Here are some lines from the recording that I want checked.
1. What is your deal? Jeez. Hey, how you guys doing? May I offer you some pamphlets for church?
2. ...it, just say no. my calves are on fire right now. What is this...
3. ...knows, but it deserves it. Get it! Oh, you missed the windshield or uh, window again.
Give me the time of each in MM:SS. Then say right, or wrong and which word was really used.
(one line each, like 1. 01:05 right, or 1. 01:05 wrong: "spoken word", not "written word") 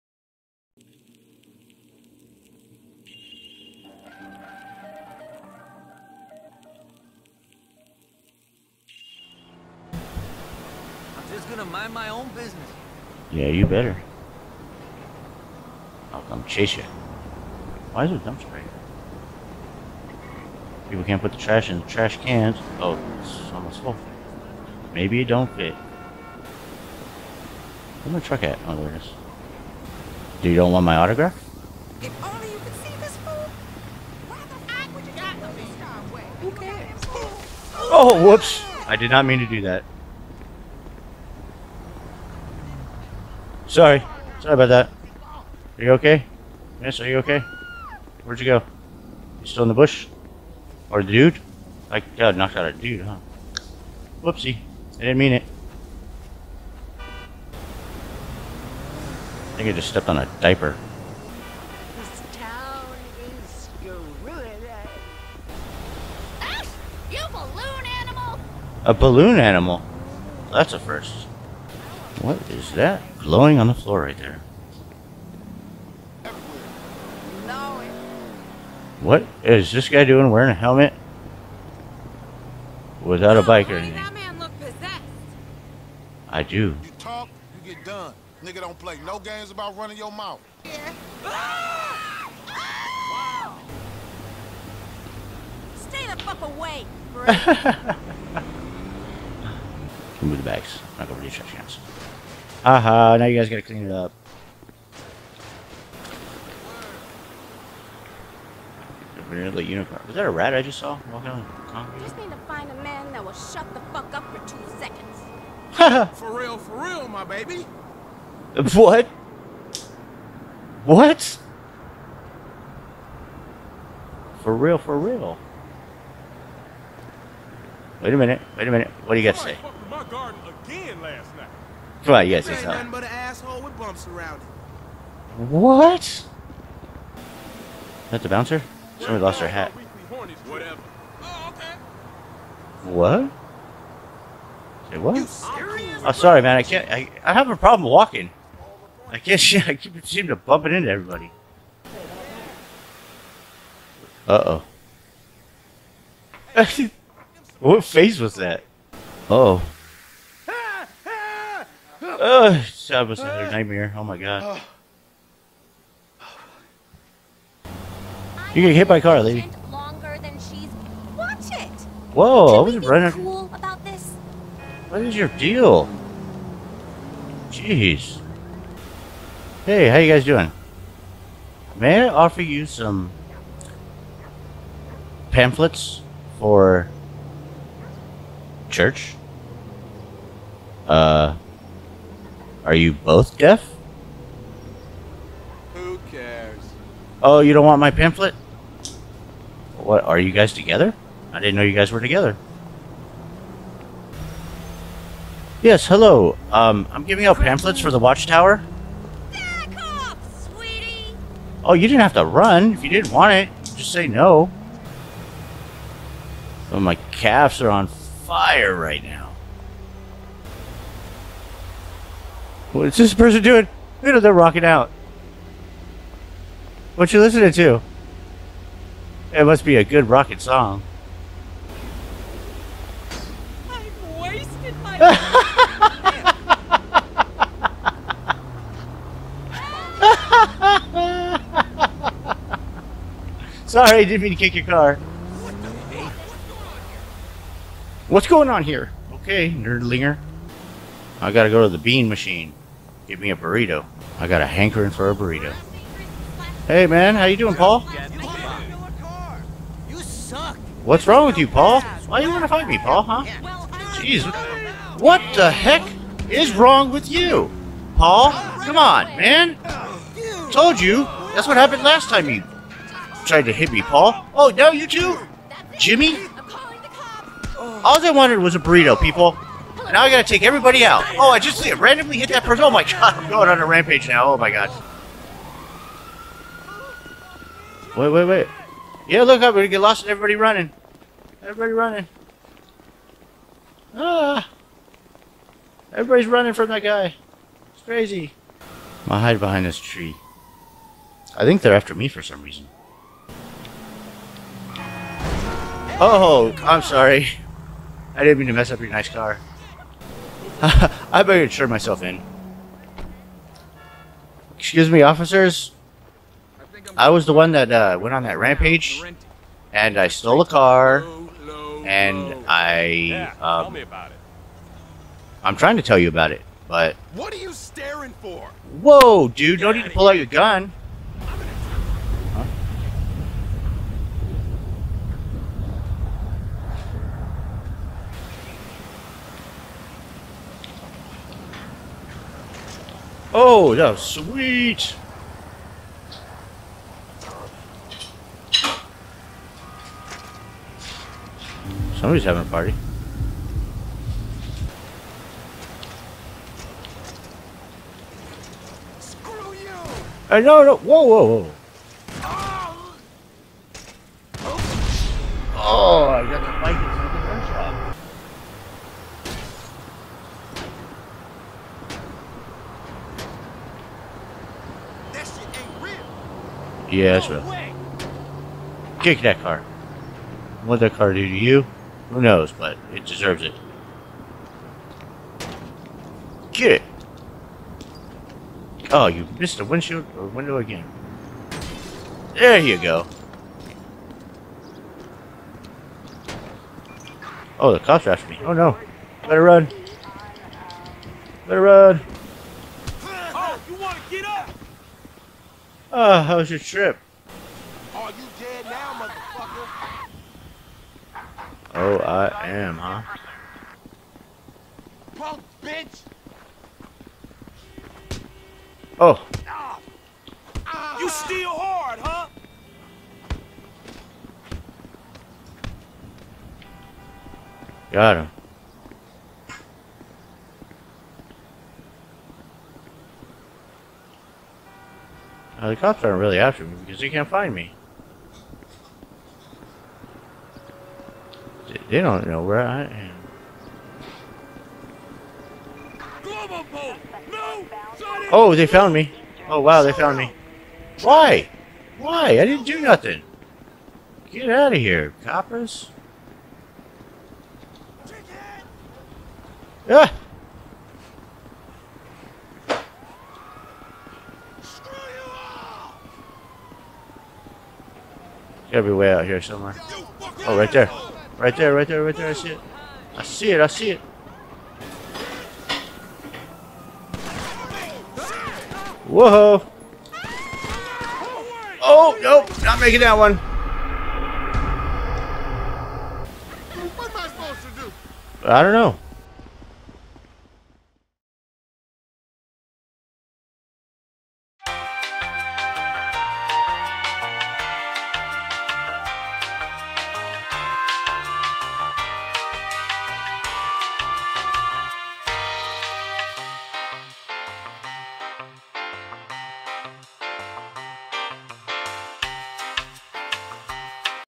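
1. 02:54 right
2. 03:33 right
3. 06:22 right.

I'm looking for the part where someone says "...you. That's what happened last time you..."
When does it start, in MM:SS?
04:30.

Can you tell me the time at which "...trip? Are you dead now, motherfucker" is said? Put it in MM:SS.
06:46.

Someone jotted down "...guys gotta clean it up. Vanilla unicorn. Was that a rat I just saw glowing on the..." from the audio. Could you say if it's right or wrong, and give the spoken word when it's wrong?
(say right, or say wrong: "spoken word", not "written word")
wrong: "walking", not "glowing".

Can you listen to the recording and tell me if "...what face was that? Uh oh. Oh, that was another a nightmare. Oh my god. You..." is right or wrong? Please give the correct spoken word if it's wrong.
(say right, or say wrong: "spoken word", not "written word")
right.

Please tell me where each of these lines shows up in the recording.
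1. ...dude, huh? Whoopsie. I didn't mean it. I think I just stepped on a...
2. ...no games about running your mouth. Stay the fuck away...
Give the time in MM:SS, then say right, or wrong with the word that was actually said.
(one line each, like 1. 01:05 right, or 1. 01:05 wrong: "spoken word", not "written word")
1. 00:52 right
2. 01:29 right.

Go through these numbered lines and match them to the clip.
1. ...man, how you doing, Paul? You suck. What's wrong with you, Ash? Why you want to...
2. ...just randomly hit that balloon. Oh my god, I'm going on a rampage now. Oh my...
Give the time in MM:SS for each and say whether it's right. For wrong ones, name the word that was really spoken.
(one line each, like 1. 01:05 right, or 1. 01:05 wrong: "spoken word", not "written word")
1. 04:16 wrong: "Paul", not "Ash"
2. 04:41 wrong: "person", not "balloon".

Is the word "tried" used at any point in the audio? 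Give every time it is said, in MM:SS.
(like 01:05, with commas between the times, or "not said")
04:33.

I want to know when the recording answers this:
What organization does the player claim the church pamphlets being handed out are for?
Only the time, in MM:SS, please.
03:27.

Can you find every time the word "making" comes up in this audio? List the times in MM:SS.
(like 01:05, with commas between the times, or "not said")
08:02.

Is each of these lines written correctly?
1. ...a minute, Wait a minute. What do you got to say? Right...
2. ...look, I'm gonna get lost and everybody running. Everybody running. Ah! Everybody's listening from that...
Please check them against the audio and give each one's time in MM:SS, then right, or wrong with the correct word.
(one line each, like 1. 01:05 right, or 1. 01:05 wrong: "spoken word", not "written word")
1. 02:08 right
2. 04:49 wrong: "running", not "listening".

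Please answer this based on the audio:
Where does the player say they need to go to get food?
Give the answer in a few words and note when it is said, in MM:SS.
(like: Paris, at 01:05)
the bean machine, at 04:11.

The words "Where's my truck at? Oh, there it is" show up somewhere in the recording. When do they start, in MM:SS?
00:28.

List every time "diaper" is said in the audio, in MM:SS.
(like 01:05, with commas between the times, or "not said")
01:00.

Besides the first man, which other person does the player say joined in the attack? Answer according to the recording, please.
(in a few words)
Jimmy.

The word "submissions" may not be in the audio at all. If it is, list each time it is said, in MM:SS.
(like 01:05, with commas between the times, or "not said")
not said.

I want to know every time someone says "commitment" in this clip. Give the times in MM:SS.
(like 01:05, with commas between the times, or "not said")
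not said.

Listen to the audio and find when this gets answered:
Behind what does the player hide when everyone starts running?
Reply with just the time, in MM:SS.
04:59.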